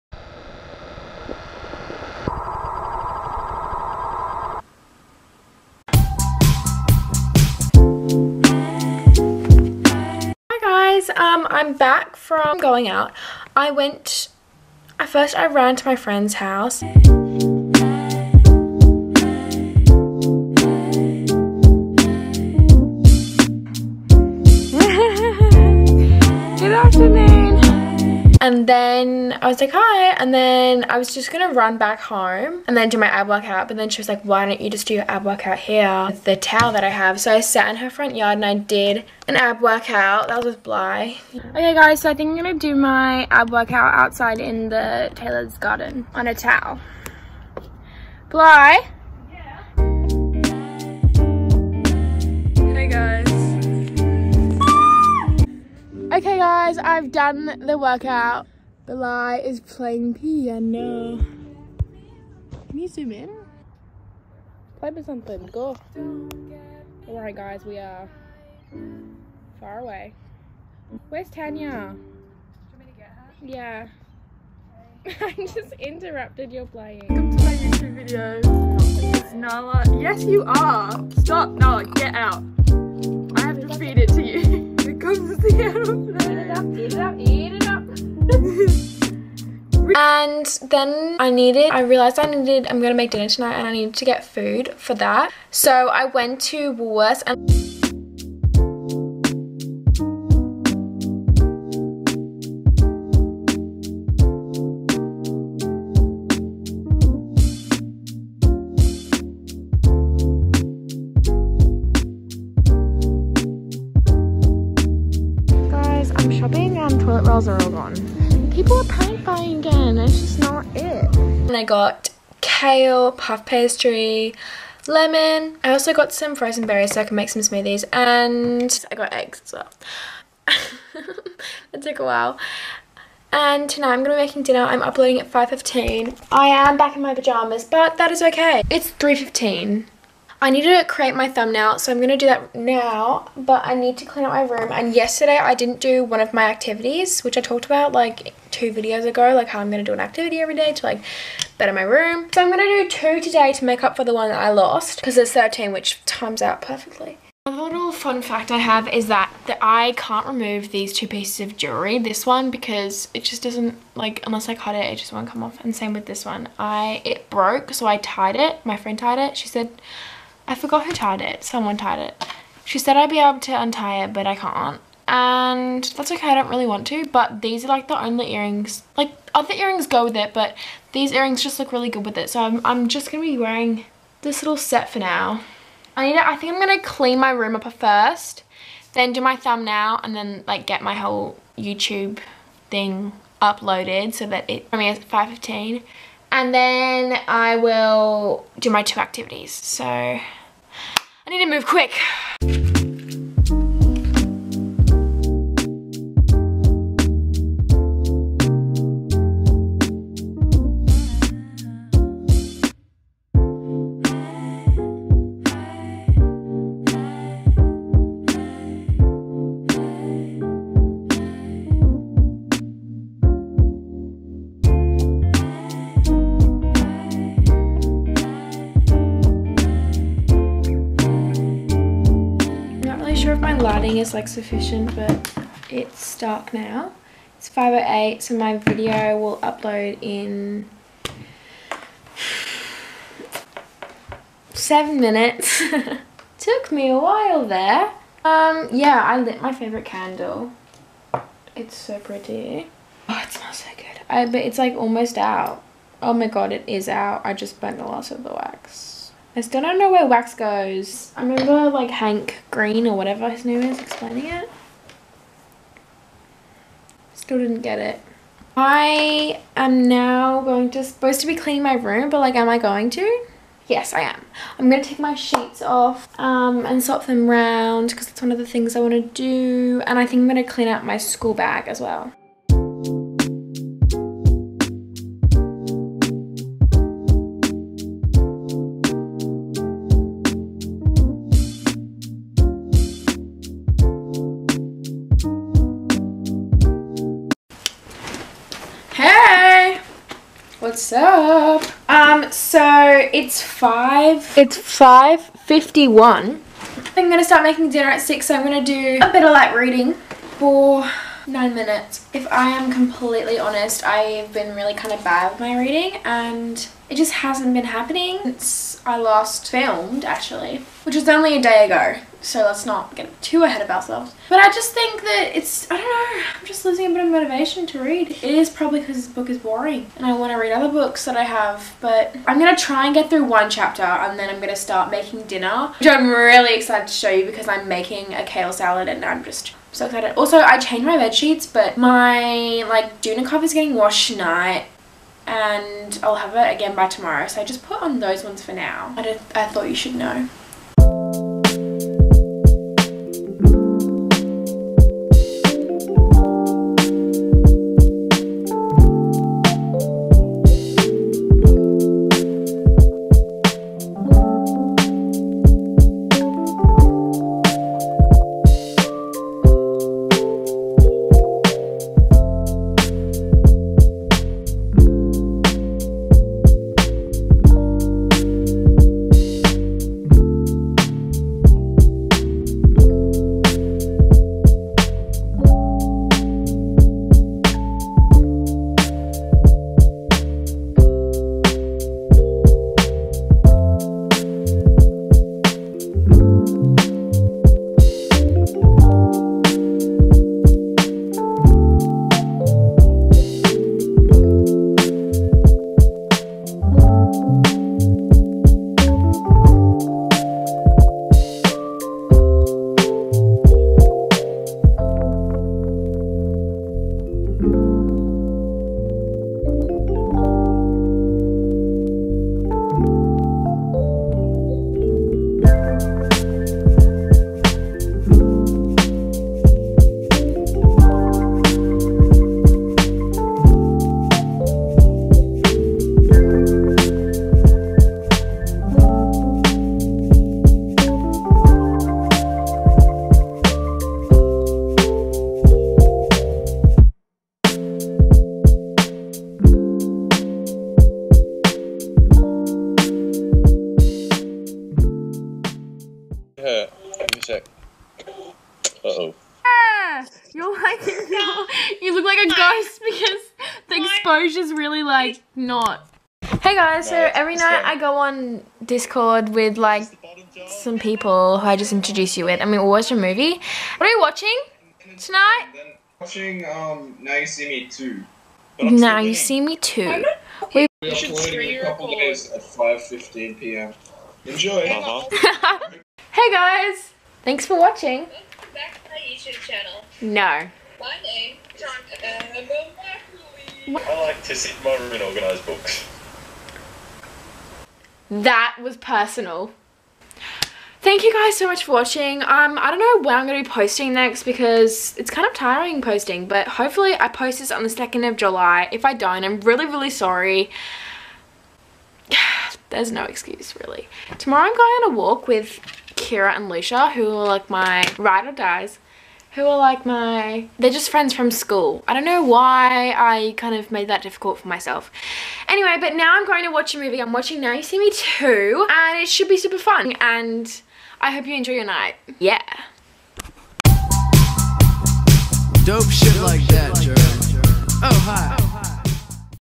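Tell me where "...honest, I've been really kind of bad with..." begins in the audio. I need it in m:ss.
5:13.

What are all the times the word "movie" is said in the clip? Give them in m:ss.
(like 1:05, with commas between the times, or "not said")
7:52, 8:46.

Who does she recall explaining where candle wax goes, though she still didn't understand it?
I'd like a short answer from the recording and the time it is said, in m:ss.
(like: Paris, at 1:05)
Hank Green, at 4:21.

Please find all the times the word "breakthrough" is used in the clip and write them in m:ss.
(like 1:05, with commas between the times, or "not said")
not said.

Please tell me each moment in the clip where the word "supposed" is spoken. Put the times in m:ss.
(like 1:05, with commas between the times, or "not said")
4:30.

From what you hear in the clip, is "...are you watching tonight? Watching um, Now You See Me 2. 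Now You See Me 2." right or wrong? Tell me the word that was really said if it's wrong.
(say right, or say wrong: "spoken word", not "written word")
right.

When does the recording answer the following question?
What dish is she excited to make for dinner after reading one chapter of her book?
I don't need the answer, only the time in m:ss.
5:38.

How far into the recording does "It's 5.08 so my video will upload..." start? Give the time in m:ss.
3:57.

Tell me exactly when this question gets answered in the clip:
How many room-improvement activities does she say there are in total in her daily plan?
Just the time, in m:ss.
2:35.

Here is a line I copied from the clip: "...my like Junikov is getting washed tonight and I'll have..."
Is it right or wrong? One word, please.
right.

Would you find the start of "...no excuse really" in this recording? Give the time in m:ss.
8:32.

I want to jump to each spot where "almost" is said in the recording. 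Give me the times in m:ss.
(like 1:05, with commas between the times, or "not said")
4:14.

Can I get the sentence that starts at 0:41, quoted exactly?
Okay guys, so I think I'm gonna do my ab workout outside in the Taylor's garden on a towel.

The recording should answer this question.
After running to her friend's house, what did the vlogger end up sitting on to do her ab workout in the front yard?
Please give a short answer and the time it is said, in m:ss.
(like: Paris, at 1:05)
A towel, at 0:36.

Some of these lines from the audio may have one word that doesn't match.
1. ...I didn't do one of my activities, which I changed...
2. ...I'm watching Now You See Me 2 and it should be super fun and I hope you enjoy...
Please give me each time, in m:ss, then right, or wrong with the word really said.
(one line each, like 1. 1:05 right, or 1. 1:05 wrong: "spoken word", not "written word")
1. 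2:25 wrong: "talked", not "changed"
2. 8:47 right.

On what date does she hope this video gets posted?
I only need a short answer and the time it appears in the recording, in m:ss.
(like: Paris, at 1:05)
2 July, at 8:27.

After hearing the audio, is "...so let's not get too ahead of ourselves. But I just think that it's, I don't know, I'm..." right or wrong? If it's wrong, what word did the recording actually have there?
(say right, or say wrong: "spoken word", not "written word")
right.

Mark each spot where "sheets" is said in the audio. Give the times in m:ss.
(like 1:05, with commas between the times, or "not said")
4:35, 5:41.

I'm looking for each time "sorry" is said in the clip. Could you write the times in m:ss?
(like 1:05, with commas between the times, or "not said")
8:29.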